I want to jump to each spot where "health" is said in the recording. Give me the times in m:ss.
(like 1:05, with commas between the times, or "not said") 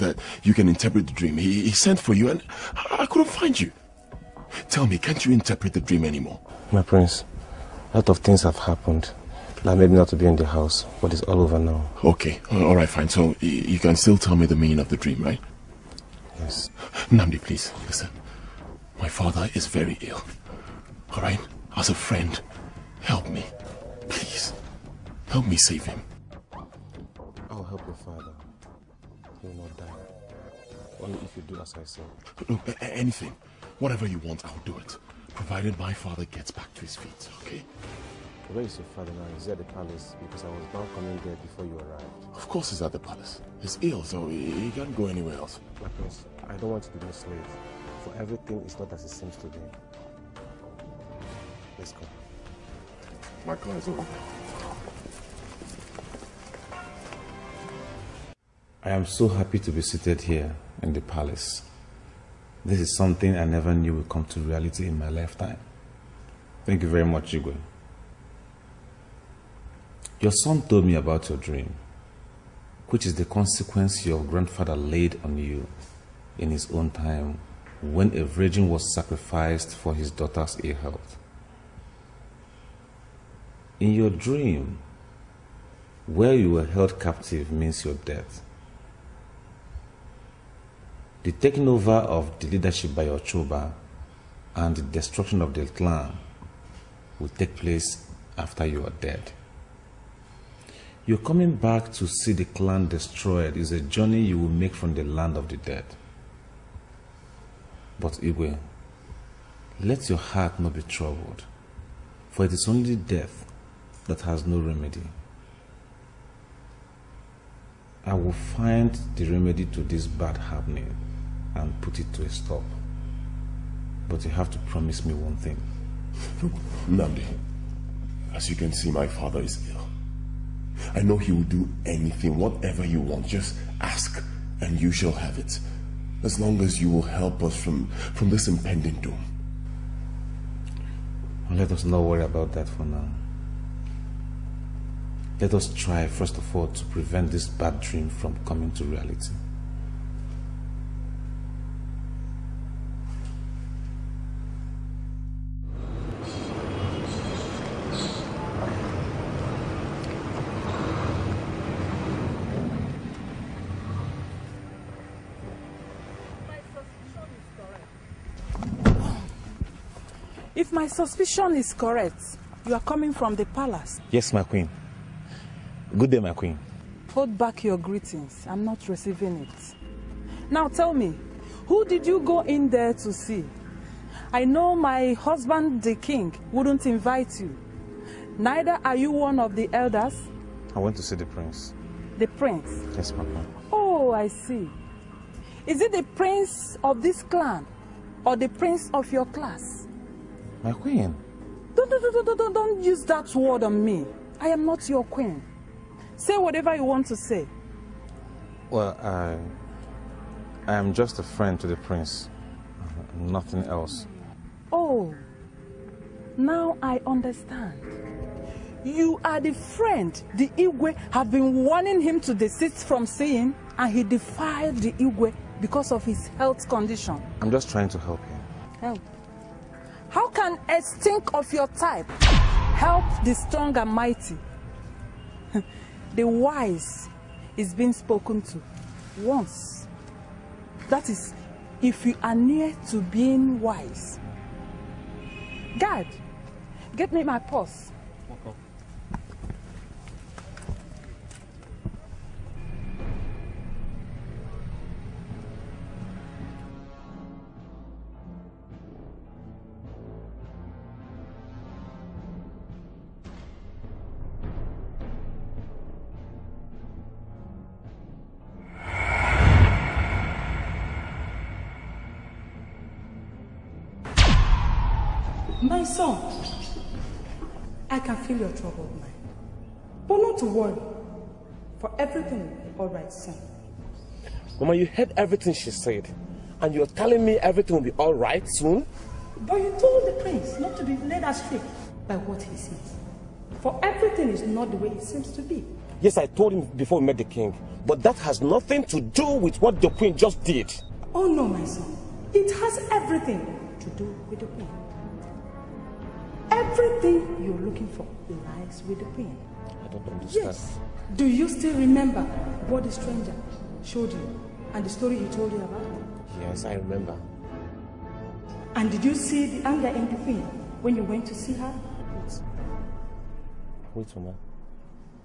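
1:20, 3:46.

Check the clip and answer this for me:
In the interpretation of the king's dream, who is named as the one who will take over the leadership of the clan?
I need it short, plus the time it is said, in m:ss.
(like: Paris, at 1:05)
Ochoba, at 1:33.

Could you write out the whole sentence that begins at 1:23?
In your dream, where you were held captive means your death.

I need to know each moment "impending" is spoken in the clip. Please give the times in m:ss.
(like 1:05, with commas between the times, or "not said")
2:18.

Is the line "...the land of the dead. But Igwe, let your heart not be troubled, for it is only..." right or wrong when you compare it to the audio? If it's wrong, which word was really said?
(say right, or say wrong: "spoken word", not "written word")
right.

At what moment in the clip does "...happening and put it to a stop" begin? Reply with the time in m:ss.
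2:00.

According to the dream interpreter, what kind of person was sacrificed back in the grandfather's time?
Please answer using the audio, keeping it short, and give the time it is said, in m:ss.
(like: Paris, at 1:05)
A virgin, at 1:18.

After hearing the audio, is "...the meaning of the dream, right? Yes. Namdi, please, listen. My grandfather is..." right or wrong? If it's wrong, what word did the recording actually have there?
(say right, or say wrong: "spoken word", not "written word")
wrong: "father", not "grandfather".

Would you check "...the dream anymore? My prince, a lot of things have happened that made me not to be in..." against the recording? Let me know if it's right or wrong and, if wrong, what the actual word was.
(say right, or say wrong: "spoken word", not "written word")
right.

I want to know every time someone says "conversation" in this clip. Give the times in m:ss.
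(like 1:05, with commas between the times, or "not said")
not said.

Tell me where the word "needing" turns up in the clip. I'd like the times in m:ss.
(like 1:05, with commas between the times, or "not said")
not said.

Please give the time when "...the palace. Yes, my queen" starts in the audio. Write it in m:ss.
2:53.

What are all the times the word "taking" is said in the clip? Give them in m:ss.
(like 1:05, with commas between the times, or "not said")
1:31.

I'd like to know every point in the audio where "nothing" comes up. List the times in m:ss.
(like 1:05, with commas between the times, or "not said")
3:33, 4:58.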